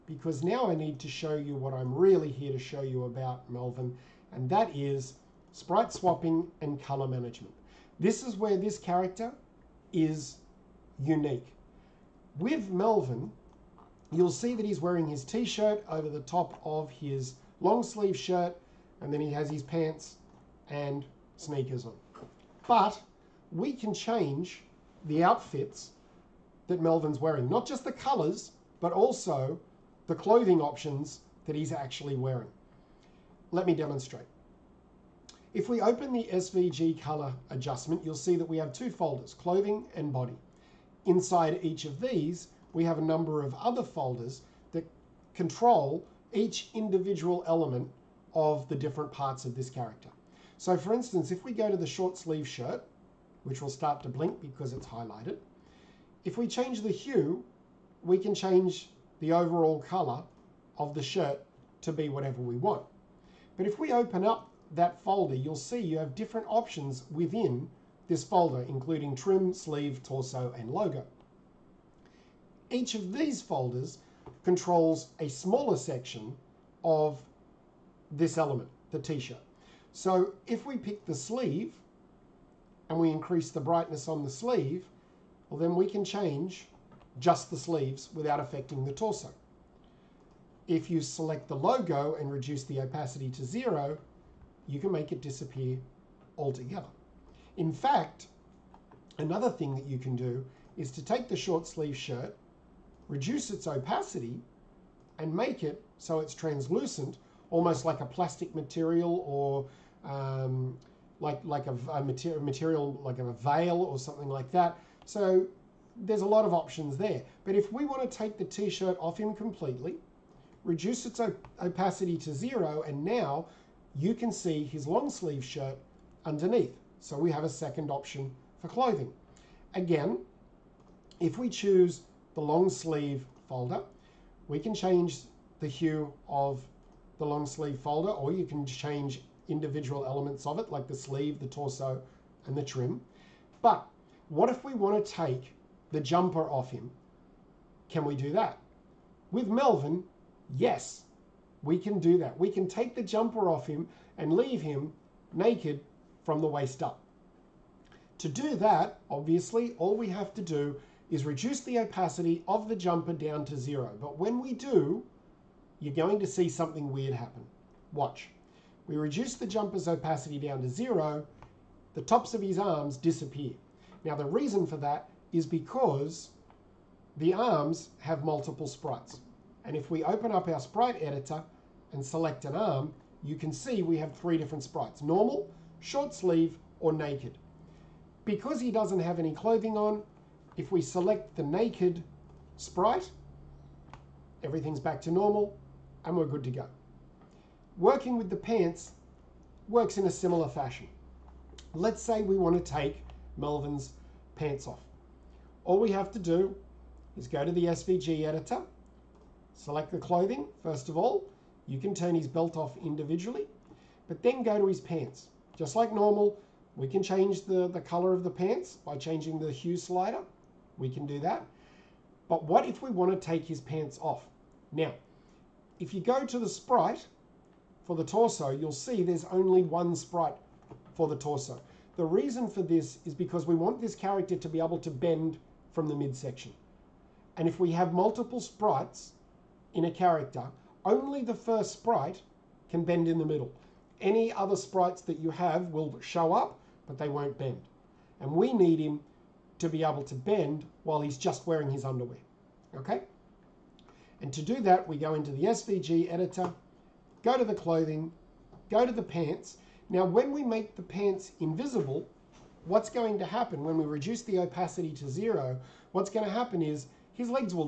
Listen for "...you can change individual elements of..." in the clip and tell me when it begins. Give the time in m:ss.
2:18.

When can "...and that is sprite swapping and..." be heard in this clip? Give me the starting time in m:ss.
0:04.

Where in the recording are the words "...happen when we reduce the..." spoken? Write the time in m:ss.
4:23.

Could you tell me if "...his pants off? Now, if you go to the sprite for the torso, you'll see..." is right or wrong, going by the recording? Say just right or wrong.
right.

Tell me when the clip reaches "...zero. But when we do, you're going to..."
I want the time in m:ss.
2:43.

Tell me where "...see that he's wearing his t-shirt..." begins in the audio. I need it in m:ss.
0:14.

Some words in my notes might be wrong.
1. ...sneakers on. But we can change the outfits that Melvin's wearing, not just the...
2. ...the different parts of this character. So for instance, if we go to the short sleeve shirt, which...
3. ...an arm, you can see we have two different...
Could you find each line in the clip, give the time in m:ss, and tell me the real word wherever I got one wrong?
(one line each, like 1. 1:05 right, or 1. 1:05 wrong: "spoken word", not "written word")
1. 0:21 right
2. 0:48 right
3. 3:02 wrong: "three", not "two".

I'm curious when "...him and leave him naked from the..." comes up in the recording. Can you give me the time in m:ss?
2:33.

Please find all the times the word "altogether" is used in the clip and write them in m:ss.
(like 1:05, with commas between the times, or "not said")
1:36.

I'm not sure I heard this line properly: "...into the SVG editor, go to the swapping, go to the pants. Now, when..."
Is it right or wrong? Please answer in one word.
wrong.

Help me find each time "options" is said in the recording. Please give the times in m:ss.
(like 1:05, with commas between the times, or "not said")
0:30, 1:06, 1:56, 2:07.